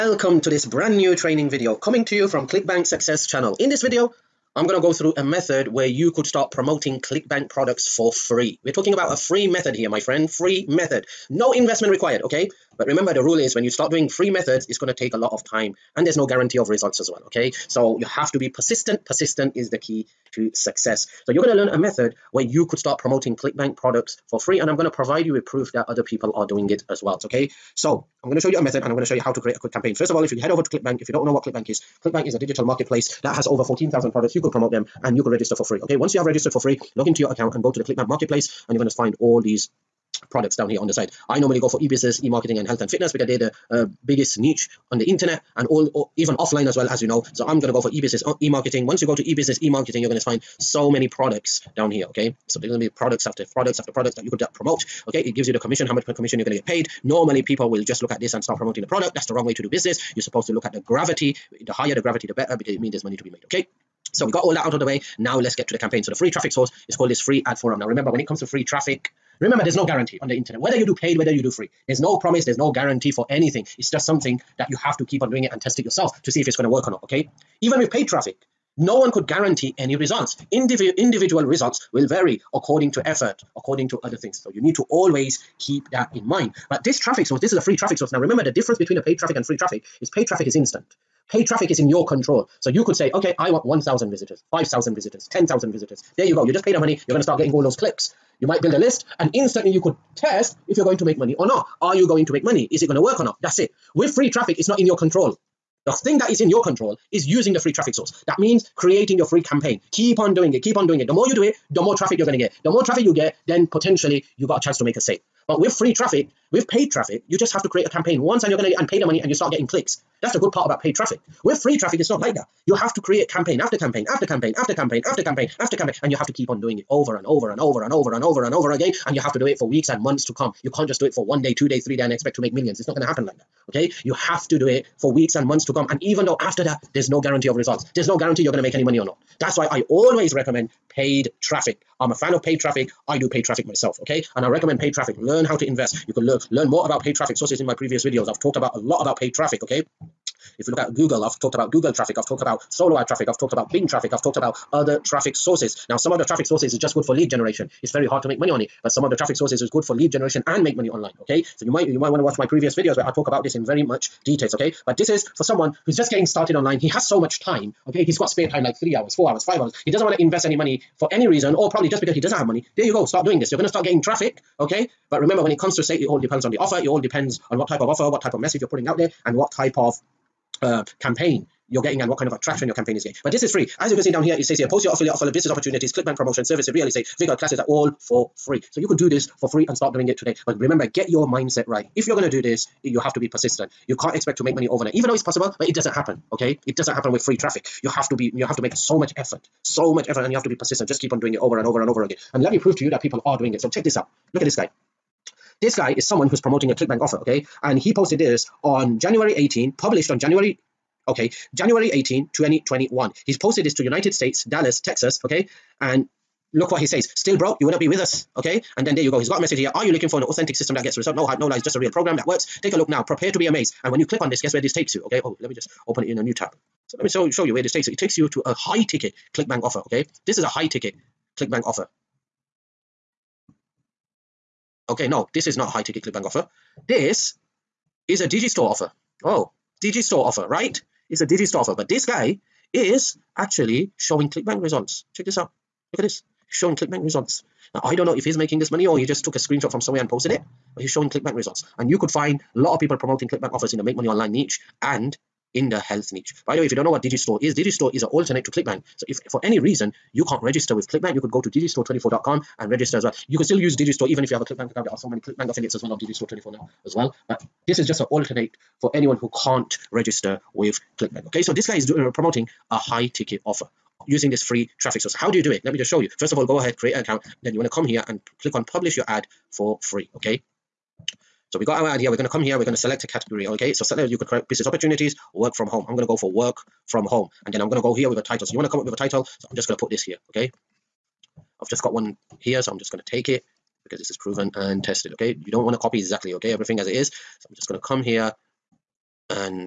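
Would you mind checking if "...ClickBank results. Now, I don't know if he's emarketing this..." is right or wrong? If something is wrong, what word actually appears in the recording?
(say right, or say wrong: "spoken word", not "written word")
wrong: "making", not "emarketing".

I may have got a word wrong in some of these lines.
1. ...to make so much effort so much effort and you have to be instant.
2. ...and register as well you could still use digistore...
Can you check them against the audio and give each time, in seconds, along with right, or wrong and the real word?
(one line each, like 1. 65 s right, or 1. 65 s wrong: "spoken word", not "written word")
1. 198 s wrong: "persistent", not "instant"
2. 262 s right.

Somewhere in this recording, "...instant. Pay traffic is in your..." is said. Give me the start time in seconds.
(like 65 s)
90 s.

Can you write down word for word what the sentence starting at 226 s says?
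So let me show, show you where this takes you.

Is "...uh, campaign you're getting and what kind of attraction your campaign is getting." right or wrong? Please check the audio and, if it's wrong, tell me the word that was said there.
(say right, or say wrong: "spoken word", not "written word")
right.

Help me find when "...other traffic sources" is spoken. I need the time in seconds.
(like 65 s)
154 s.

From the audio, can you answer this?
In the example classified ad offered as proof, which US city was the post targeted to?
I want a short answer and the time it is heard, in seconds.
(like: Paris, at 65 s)
Dallas, Texas, at 214 s.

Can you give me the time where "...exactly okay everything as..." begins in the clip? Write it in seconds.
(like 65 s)
295 s.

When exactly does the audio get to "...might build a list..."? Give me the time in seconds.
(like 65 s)
98 s.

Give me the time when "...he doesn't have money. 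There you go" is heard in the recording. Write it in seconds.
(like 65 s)
172 s.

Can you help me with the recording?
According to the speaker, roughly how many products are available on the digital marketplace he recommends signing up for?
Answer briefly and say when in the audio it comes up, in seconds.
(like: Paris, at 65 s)
14,000, at 33 s.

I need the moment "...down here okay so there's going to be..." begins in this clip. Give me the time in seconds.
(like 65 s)
51 s.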